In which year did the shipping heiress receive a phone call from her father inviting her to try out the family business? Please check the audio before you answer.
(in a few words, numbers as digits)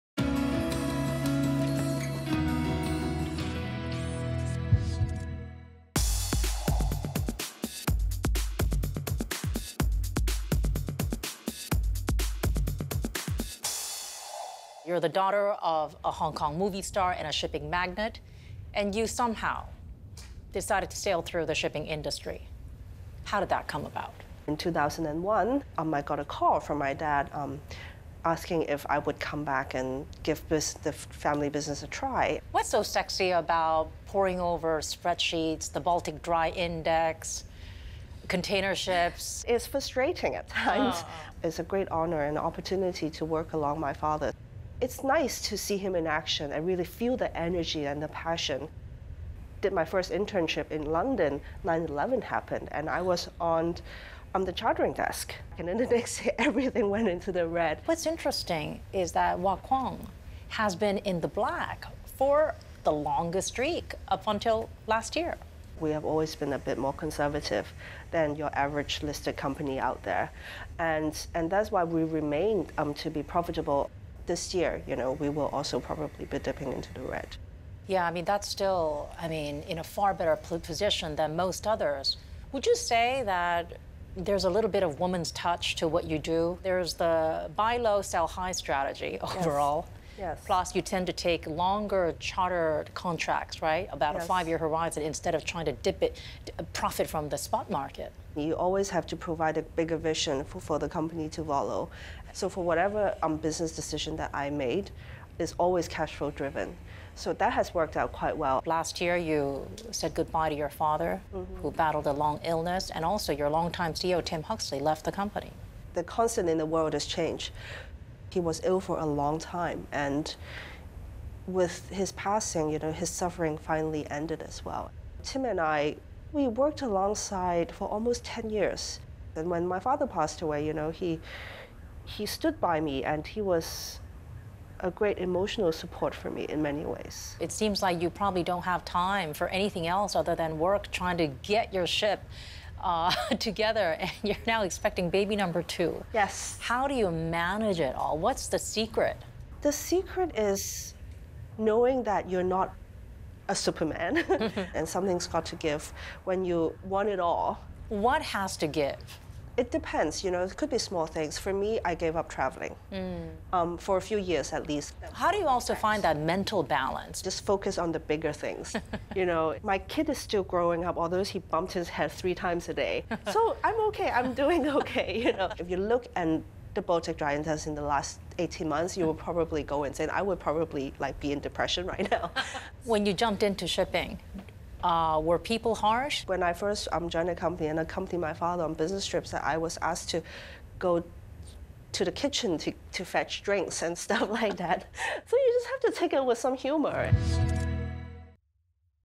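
2001.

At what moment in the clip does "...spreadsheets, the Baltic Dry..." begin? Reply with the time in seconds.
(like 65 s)
34 s.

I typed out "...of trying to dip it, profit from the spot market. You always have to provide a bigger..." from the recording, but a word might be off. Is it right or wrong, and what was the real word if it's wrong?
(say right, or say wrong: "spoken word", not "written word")
right.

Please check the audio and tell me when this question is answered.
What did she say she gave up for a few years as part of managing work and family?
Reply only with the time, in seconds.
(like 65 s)
162 s.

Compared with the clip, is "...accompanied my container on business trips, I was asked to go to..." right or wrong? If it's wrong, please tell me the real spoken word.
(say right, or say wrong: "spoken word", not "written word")
wrong: "father", not "container".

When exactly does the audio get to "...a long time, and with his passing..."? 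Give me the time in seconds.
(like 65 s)
118 s.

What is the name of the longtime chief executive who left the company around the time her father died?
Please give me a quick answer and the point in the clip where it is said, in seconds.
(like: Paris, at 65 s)
Tim Huxley, at 114 s.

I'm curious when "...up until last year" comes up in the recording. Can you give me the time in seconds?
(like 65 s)
64 s.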